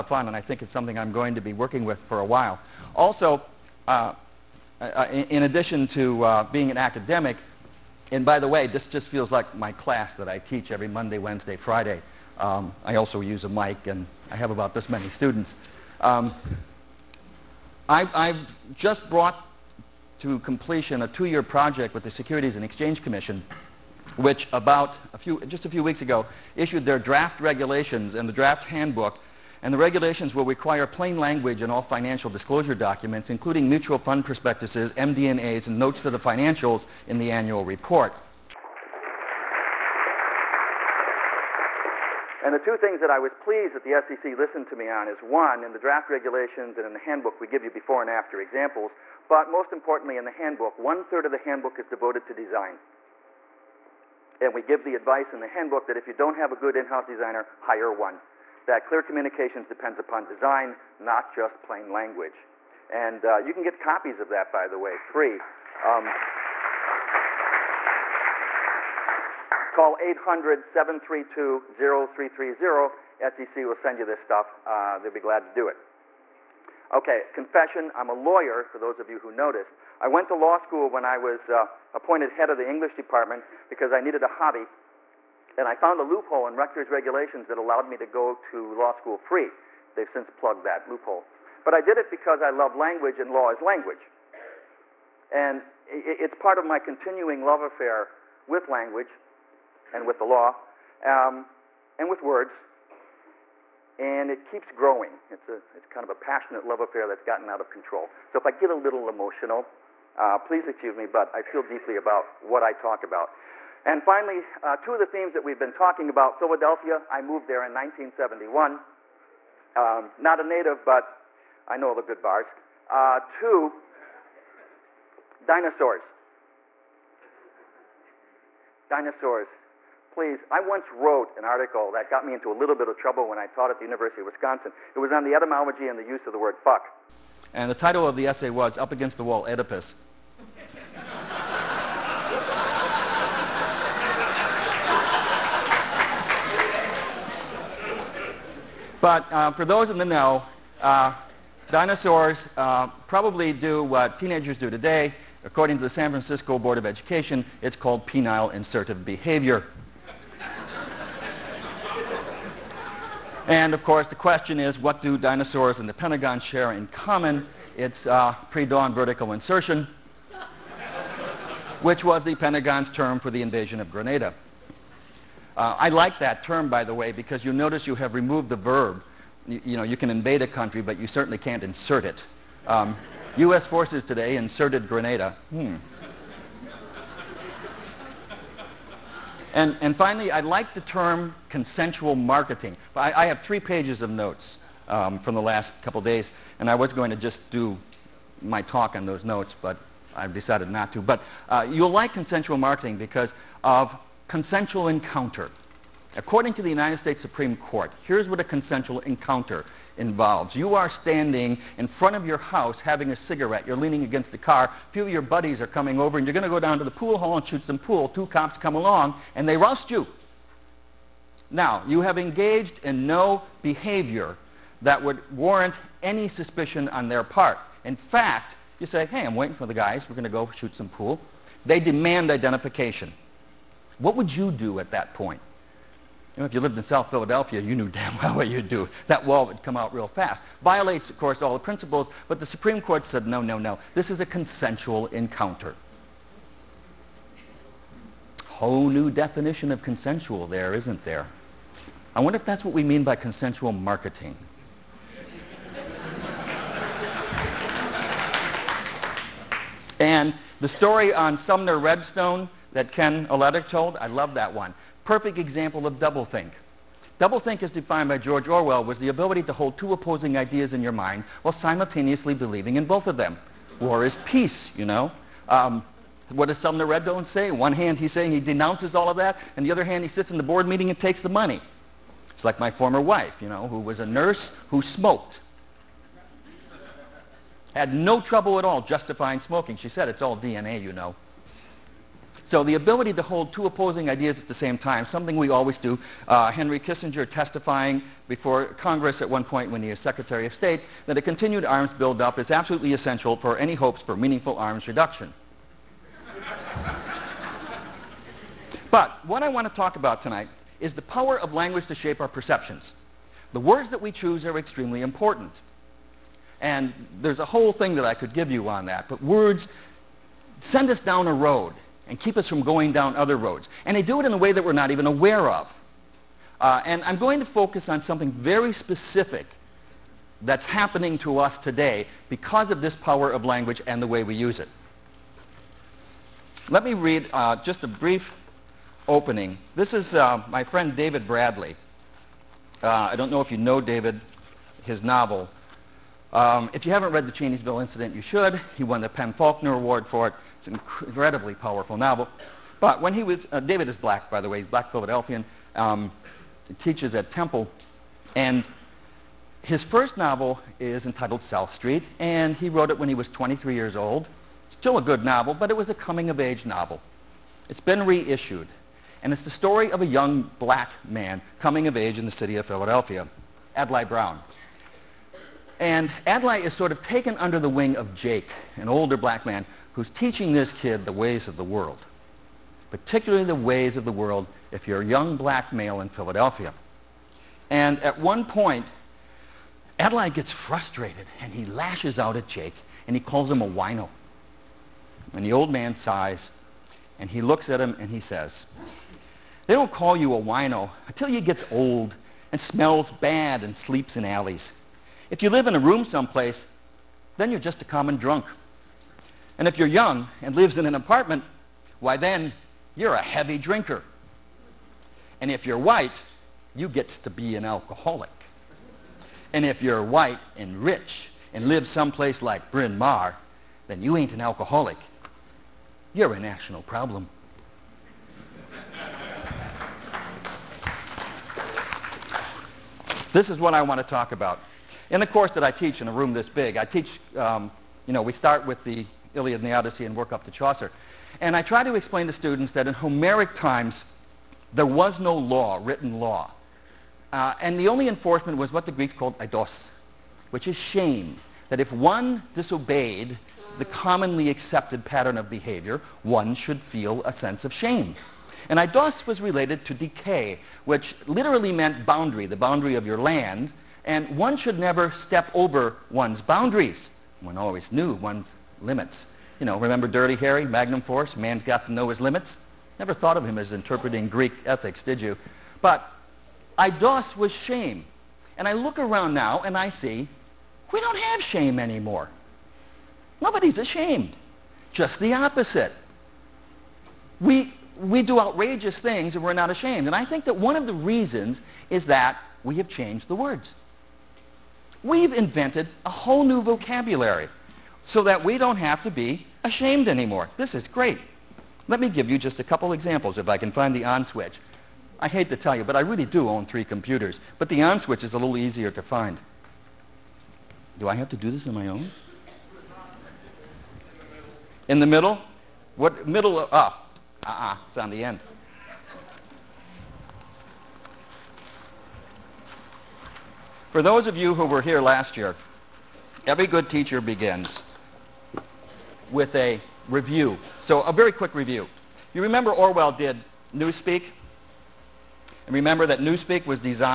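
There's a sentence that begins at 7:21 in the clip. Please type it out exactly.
And I try to explain to students that in Homeric times, there was no law, written law.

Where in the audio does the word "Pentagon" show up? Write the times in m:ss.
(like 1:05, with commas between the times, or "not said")
2:45, 2:52.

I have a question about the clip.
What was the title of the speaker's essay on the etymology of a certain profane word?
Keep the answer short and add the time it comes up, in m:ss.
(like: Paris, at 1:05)
Up Against the Wall Oedipus, at 2:18.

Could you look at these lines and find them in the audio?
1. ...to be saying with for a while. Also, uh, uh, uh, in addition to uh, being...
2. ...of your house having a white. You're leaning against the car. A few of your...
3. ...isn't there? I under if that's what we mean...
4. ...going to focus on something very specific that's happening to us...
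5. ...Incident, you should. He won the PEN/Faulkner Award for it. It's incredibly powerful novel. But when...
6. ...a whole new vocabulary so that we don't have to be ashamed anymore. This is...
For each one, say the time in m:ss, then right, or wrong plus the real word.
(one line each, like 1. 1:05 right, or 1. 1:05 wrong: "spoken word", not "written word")
1. 0:01 wrong: "working", not "saying"
2. 3:32 wrong: "cigarette", not "white"
3. 4:10 wrong: "wonder", not "under"
4. 5:27 right
5. 5:47 right
6. 8:16 right.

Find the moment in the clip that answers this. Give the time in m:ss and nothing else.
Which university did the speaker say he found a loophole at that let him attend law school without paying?
1:26.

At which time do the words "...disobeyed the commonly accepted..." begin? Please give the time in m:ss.
7:32.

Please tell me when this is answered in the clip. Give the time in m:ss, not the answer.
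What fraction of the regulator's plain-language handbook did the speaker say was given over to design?
0:50.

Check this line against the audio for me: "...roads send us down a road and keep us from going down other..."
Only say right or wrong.
wrong.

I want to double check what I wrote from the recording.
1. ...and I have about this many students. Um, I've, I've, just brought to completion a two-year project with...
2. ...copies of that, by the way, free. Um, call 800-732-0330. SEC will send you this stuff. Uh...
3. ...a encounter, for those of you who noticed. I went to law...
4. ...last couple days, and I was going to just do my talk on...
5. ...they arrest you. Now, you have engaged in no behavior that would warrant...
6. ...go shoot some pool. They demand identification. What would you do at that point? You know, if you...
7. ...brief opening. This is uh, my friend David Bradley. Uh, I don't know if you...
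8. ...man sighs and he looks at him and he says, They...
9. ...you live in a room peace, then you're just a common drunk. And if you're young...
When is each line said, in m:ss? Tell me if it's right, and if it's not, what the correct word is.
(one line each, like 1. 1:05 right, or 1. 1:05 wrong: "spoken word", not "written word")
1. 0:13 right
2. 1:03 right
3. 1:18 wrong: "lawyer", not "encounter"
4. 3:15 right
5. 3:39 right
6. 3:50 right
7. 5:37 right
8. 6:35 right
9. 6:45 wrong: "someplace", not "peace".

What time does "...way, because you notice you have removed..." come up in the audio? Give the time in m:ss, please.
2:56.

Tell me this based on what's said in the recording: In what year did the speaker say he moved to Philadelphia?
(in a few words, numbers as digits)
1971.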